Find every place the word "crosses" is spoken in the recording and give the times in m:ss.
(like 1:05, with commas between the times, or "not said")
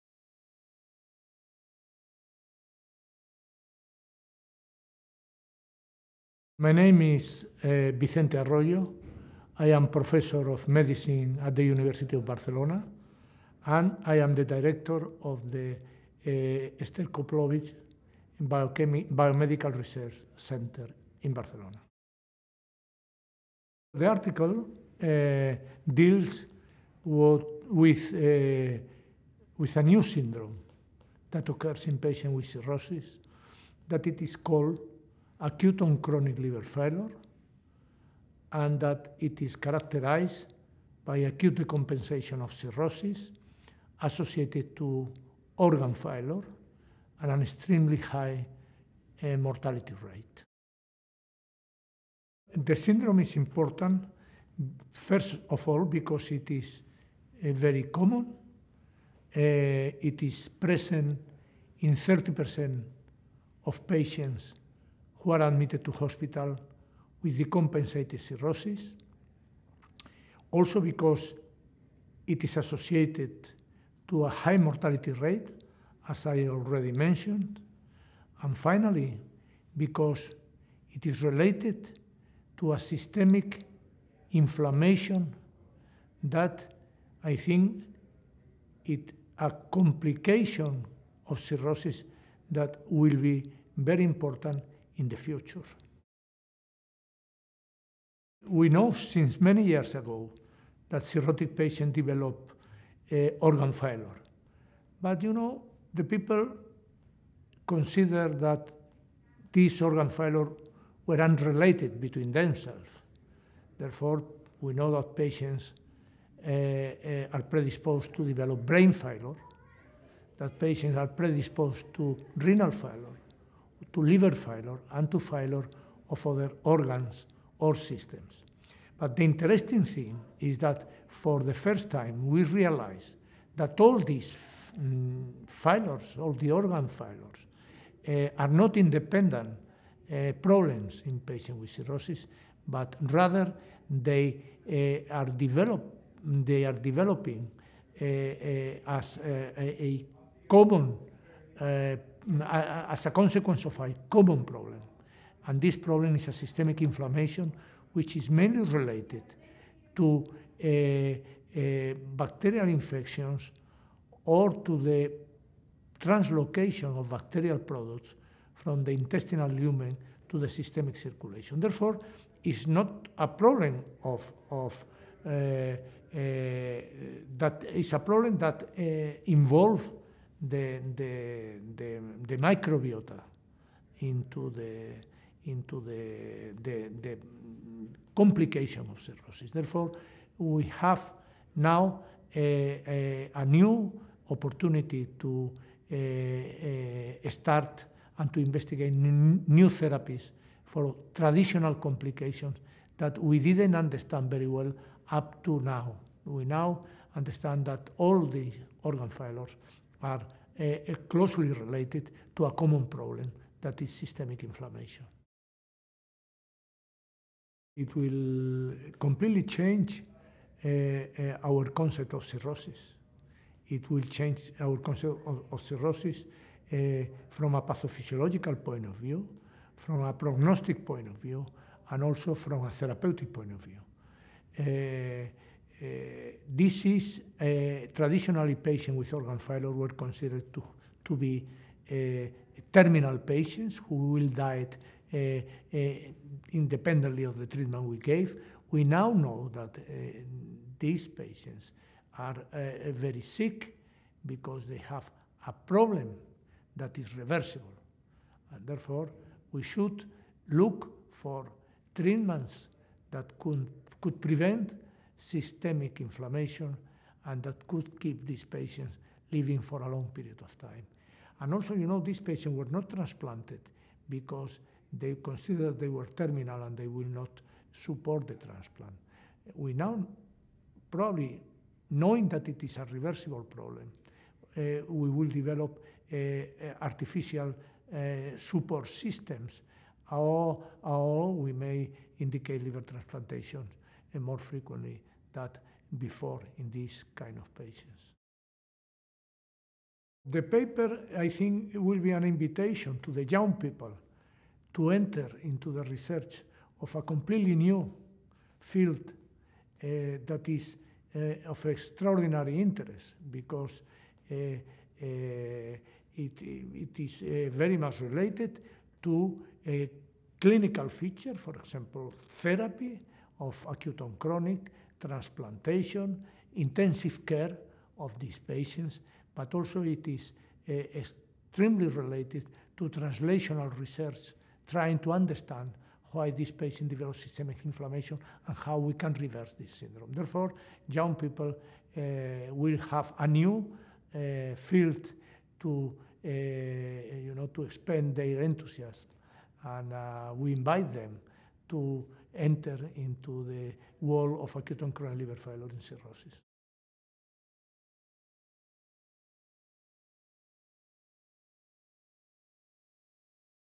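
not said.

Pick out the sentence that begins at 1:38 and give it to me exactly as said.
We know since many years ago that cirrhotic patients develop uh, organ failure.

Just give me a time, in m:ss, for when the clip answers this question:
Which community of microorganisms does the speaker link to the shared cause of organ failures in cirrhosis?
3:02.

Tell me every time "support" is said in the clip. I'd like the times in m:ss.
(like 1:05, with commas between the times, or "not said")
4:37, 4:48.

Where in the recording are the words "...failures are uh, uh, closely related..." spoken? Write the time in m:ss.
3:29.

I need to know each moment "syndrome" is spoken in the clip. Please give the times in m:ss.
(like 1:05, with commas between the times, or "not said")
0:30, 0:52, 5:39.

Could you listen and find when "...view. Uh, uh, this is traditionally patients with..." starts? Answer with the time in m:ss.
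3:53.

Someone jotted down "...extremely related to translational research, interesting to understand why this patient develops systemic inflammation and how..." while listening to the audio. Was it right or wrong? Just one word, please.
wrong.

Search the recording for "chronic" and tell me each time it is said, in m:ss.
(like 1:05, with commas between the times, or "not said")
0:35, 5:24, 5:54.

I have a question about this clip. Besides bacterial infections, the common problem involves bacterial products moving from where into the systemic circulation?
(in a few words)
the intestinal lumen.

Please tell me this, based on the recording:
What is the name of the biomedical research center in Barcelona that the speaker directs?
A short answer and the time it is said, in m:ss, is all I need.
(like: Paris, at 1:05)
Esther Koplowitz, at 0:16.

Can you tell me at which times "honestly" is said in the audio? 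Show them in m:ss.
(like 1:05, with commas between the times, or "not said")
not said.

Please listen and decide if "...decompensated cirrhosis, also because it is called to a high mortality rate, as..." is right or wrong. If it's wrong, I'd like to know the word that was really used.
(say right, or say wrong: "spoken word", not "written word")
wrong: "associated", not "called".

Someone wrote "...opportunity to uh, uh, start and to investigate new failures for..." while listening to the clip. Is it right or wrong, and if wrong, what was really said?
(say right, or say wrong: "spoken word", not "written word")
wrong: "therapies", not "failures".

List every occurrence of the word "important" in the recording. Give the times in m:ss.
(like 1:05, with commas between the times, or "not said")
0:53, 1:34.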